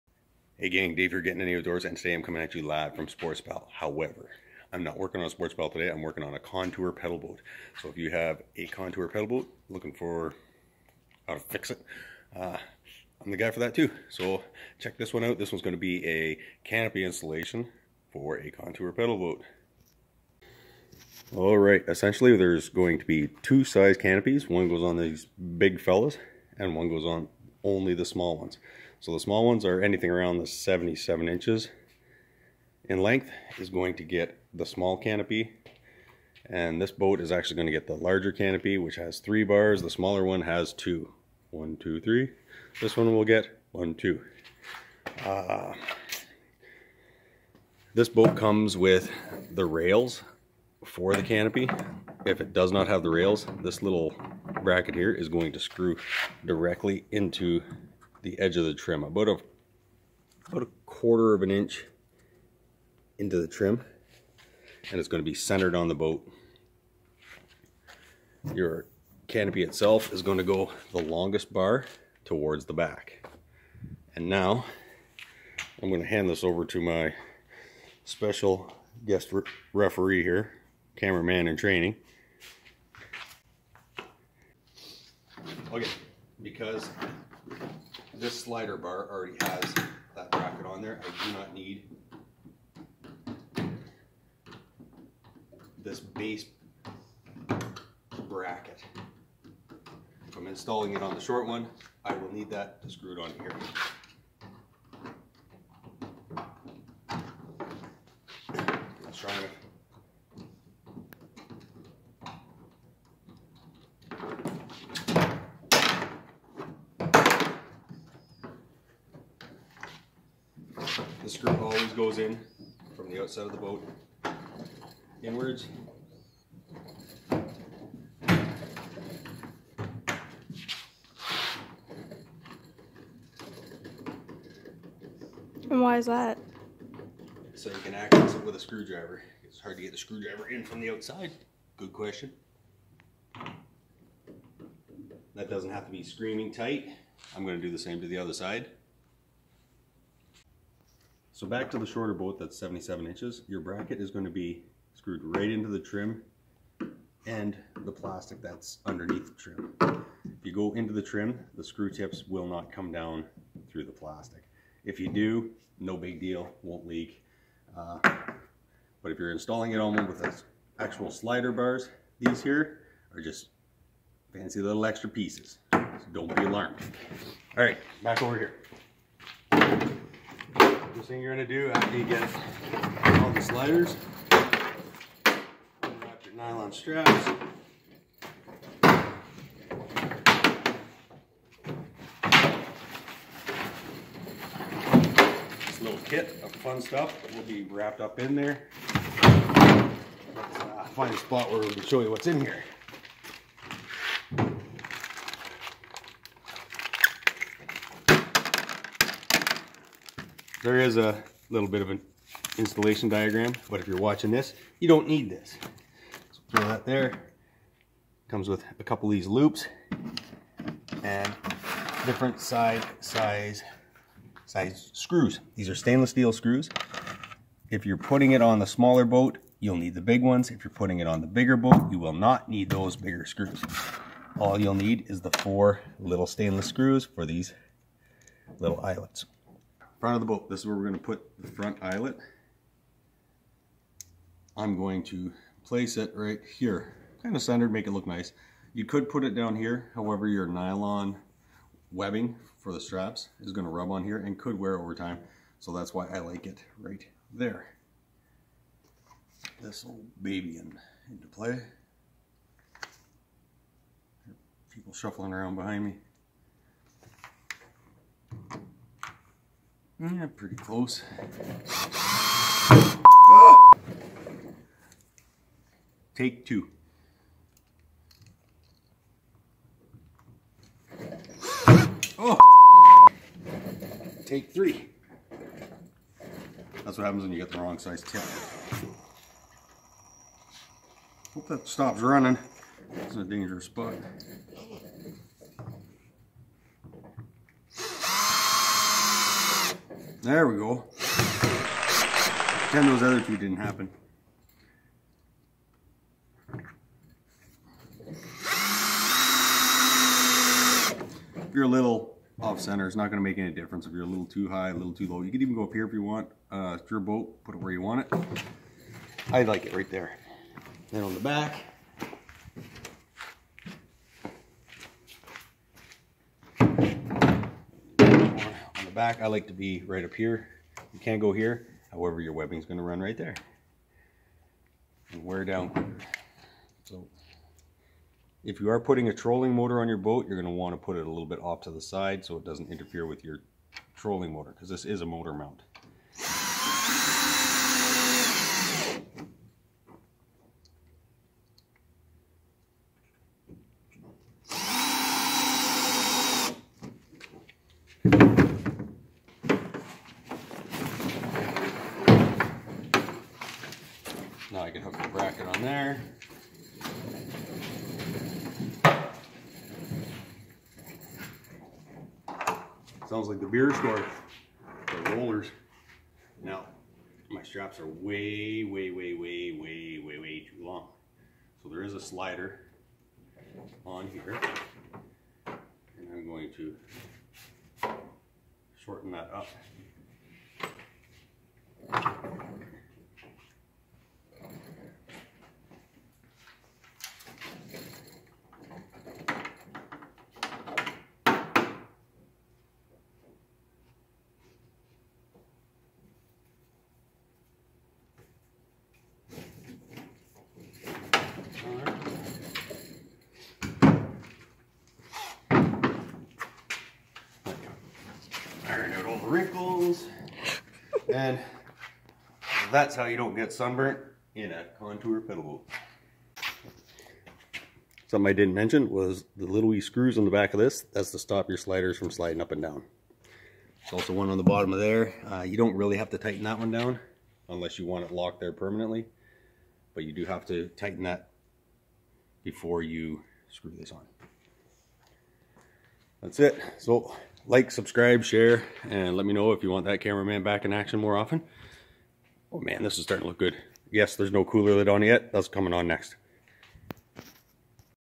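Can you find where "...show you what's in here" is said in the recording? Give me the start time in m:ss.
3:21.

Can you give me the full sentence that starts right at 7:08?
Something I didn't mention was the little wee screws on the back of this.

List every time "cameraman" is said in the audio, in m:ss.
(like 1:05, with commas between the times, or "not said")
1:20, 7:30.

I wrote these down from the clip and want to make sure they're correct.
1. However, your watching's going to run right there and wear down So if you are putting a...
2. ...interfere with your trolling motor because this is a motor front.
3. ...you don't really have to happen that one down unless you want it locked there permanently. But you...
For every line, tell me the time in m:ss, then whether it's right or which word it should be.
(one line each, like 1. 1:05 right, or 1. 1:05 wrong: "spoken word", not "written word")
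1. 5:31 wrong: "webbing", not "watching"
2. 5:42 wrong: "mount", not "front"
3. 7:15 wrong: "tighten", not "happen".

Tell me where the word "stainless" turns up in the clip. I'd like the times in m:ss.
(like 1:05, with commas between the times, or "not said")
3:45, 3:56.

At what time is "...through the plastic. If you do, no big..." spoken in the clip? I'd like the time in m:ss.
2:43.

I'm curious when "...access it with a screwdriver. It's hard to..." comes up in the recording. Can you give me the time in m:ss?
2:17.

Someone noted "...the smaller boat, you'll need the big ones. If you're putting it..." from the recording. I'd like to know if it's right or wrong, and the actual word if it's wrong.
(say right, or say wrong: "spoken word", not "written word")
right.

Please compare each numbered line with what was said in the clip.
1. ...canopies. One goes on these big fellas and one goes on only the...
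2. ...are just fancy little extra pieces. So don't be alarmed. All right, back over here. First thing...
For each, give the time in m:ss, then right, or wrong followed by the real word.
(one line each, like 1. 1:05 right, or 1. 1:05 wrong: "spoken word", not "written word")
1. 0:23 right
2. 2:53 right.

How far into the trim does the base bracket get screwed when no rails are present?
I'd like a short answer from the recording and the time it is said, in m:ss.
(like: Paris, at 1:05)
a quarter of an inch, at 1:00.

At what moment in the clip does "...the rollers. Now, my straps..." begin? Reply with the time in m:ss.
6:15.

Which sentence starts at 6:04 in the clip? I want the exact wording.
I can hook the bracket on there.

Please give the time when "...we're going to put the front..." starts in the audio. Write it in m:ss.
4:00.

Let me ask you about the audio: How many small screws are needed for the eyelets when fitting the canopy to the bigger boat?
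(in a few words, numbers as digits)
4.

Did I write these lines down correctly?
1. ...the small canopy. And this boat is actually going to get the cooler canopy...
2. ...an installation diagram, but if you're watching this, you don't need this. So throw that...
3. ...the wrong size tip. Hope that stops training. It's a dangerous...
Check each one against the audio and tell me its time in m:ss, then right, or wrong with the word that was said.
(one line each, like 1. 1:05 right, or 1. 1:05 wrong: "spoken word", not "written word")
1. 0:34 wrong: "larger", not "cooler"
2. 3:31 right
3. 4:47 wrong: "running", not "training".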